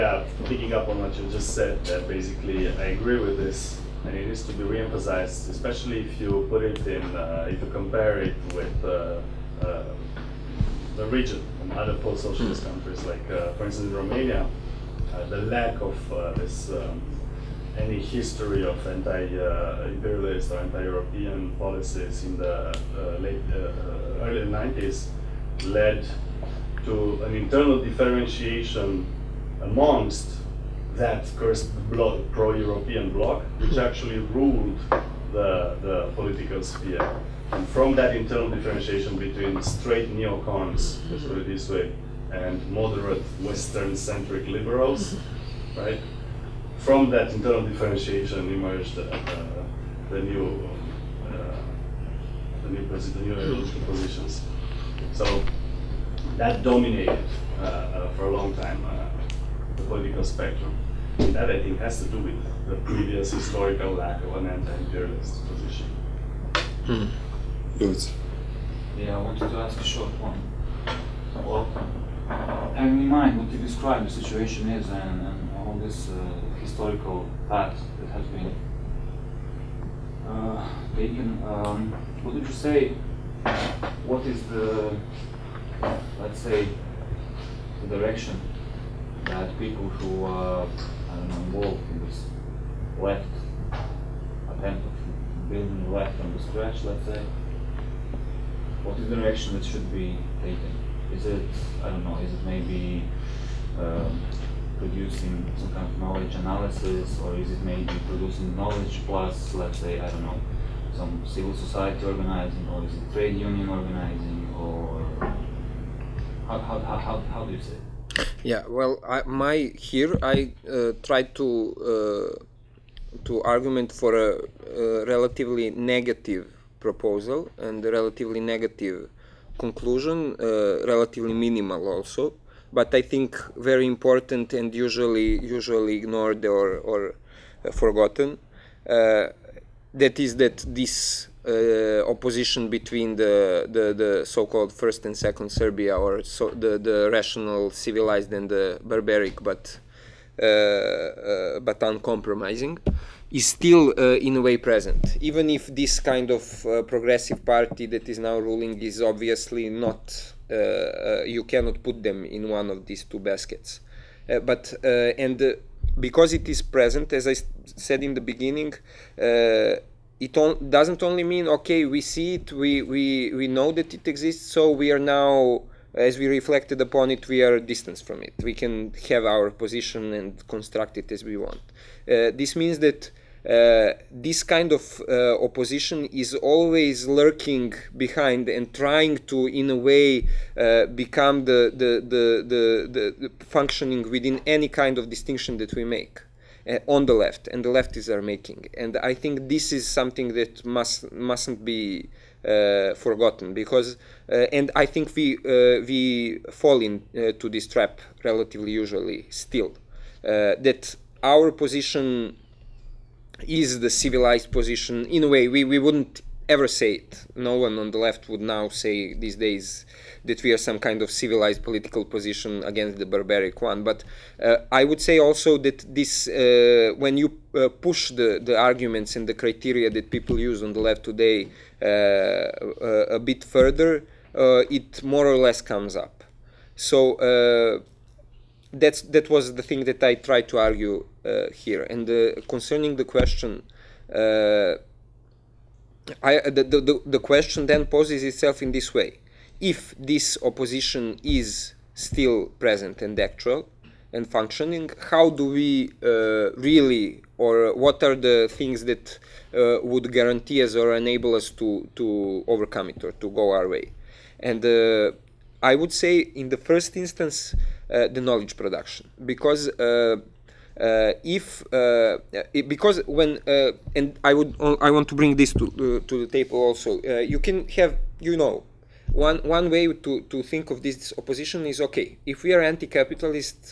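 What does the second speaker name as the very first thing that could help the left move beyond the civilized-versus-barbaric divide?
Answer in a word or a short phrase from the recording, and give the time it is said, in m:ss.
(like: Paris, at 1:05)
knowledge production, at 4:28.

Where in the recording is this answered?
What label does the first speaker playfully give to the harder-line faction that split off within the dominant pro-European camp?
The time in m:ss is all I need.
0:39.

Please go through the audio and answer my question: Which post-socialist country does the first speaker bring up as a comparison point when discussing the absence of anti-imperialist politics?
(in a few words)
Romania.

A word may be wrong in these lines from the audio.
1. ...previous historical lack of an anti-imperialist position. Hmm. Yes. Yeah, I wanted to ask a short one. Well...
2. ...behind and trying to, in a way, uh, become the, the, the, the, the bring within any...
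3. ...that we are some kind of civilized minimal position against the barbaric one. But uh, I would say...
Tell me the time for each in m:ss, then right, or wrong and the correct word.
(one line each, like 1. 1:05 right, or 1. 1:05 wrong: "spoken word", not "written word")
1. 1:02 right
2. 3:07 wrong: "functioning", not "bring"
3. 3:40 wrong: "political", not "minimal".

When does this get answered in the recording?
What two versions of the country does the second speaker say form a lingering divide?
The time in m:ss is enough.
2:24.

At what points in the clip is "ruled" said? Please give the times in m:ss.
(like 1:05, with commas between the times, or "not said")
0:34.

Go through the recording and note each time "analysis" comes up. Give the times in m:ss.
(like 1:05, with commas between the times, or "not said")
1:46.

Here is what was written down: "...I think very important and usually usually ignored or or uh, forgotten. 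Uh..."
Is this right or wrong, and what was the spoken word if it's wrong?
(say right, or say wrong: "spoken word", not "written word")
right.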